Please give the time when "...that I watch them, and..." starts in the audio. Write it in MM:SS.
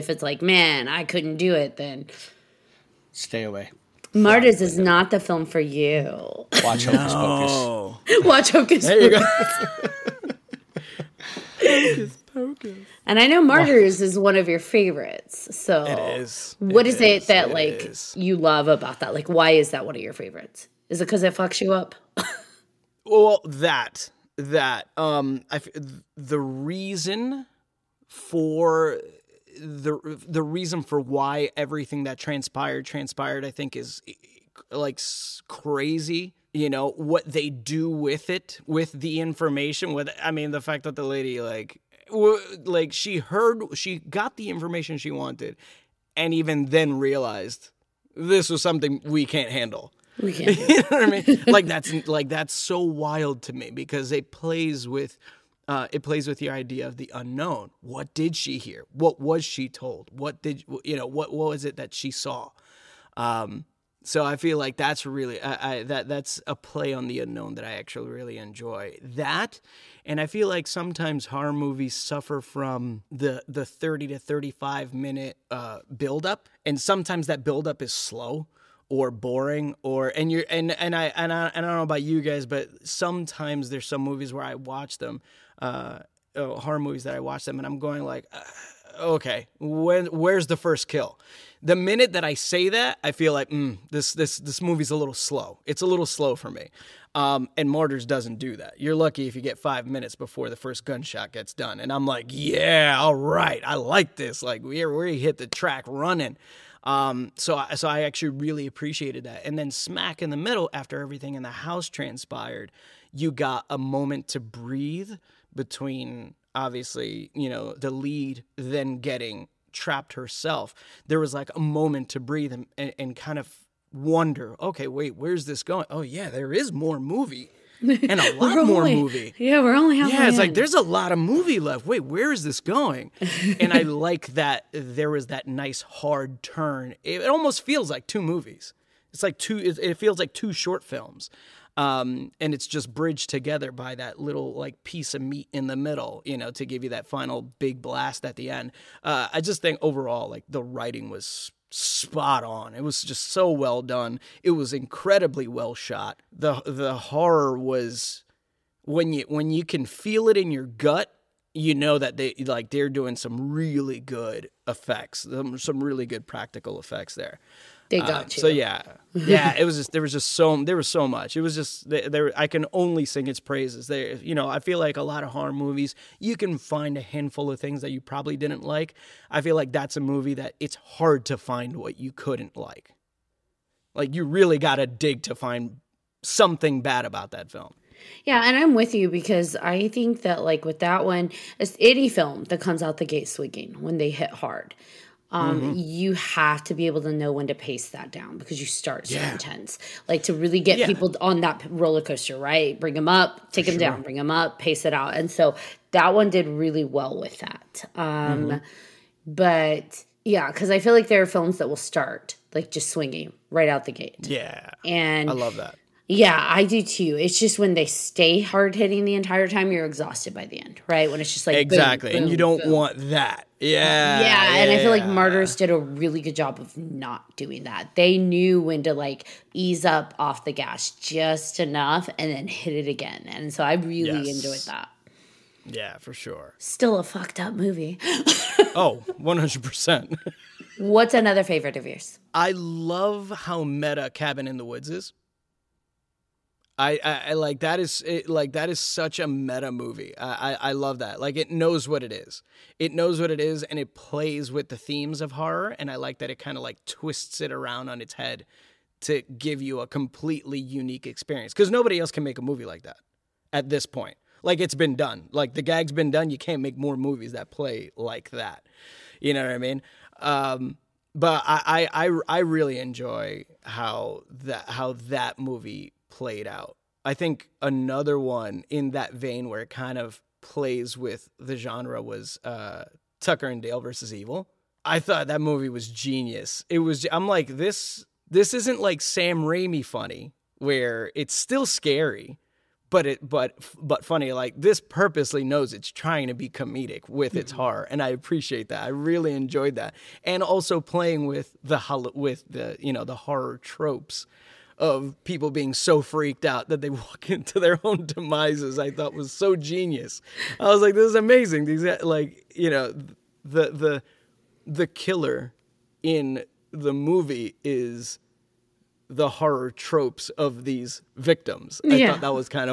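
01:27.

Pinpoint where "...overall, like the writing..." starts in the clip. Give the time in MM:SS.
02:29.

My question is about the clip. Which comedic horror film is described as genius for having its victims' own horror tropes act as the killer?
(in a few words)
Tucker and Dale versus Evil.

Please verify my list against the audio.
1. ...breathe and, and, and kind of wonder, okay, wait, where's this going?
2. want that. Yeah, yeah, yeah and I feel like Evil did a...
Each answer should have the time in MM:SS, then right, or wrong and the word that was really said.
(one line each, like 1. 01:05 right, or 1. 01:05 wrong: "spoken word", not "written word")
1. 02:02 right
2. 03:42 wrong: "Martyrs", not "Evil".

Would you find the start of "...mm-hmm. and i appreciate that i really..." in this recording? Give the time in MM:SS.
04:57.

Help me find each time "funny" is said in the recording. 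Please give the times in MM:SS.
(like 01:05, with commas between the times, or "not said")
04:49, 04:54.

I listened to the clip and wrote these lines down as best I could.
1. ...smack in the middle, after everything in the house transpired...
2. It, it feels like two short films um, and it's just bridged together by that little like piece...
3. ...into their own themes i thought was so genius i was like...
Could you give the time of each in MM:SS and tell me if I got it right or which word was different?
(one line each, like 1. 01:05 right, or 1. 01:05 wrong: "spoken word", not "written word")
1. 01:49 right
2. 02:19 right
3. 05:07 wrong: "demises", not "themes".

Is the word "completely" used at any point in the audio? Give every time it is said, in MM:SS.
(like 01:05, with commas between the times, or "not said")
04:19.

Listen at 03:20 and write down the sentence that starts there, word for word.
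people on that roller coaster, right?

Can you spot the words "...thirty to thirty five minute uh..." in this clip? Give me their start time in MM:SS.
01:13.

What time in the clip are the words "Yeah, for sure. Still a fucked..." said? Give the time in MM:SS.
03:55.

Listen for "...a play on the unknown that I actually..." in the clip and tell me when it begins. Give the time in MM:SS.
01:06.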